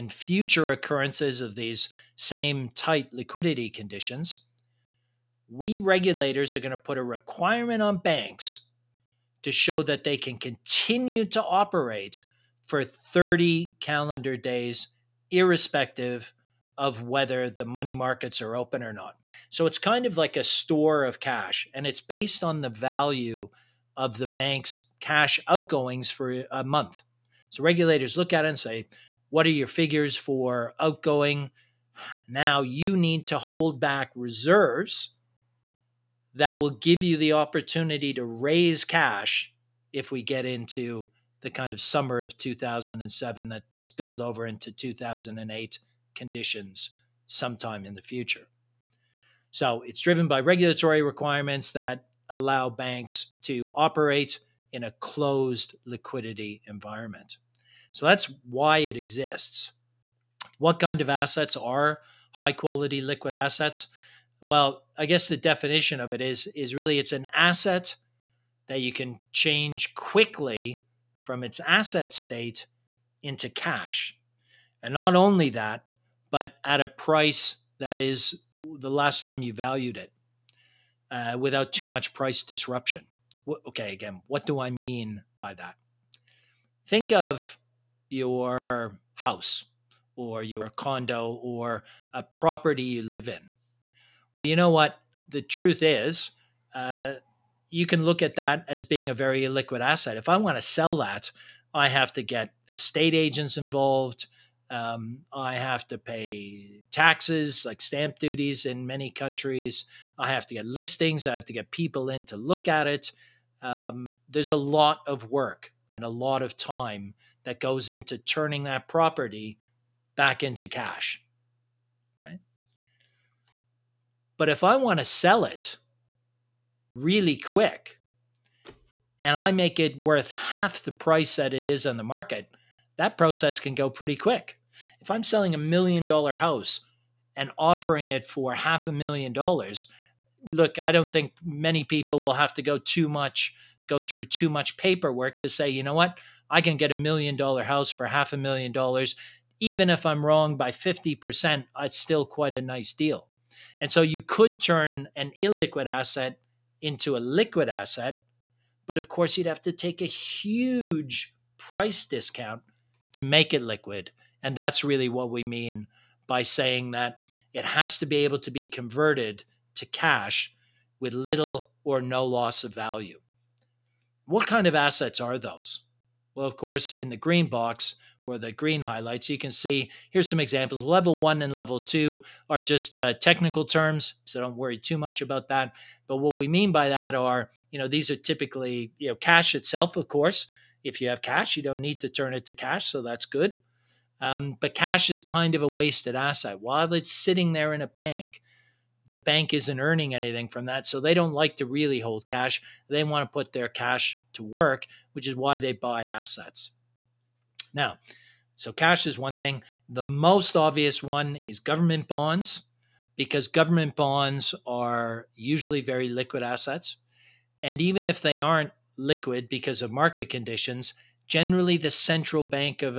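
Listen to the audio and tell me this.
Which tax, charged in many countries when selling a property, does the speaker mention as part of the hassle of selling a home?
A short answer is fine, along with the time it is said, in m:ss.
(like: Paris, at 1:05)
stamp duties, at 1:47.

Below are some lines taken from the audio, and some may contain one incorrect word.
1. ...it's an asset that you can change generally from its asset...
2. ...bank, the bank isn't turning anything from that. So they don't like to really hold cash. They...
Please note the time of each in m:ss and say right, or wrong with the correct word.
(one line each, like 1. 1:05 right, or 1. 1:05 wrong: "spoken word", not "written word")
1. 1:06 wrong: "quickly", not "generally"
2. 3:17 wrong: "earning", not "turning".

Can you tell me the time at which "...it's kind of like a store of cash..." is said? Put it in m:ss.
0:19.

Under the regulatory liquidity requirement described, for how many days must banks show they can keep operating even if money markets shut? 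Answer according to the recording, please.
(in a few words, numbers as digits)
30 calendar days.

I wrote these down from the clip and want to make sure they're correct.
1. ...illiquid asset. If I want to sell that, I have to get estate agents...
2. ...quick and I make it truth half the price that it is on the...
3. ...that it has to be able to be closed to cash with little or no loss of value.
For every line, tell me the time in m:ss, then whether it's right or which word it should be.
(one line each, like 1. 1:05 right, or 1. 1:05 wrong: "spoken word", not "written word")
1. 1:39 right
2. 2:07 wrong: "worth", not "truth"
3. 2:46 wrong: "converted", not "closed".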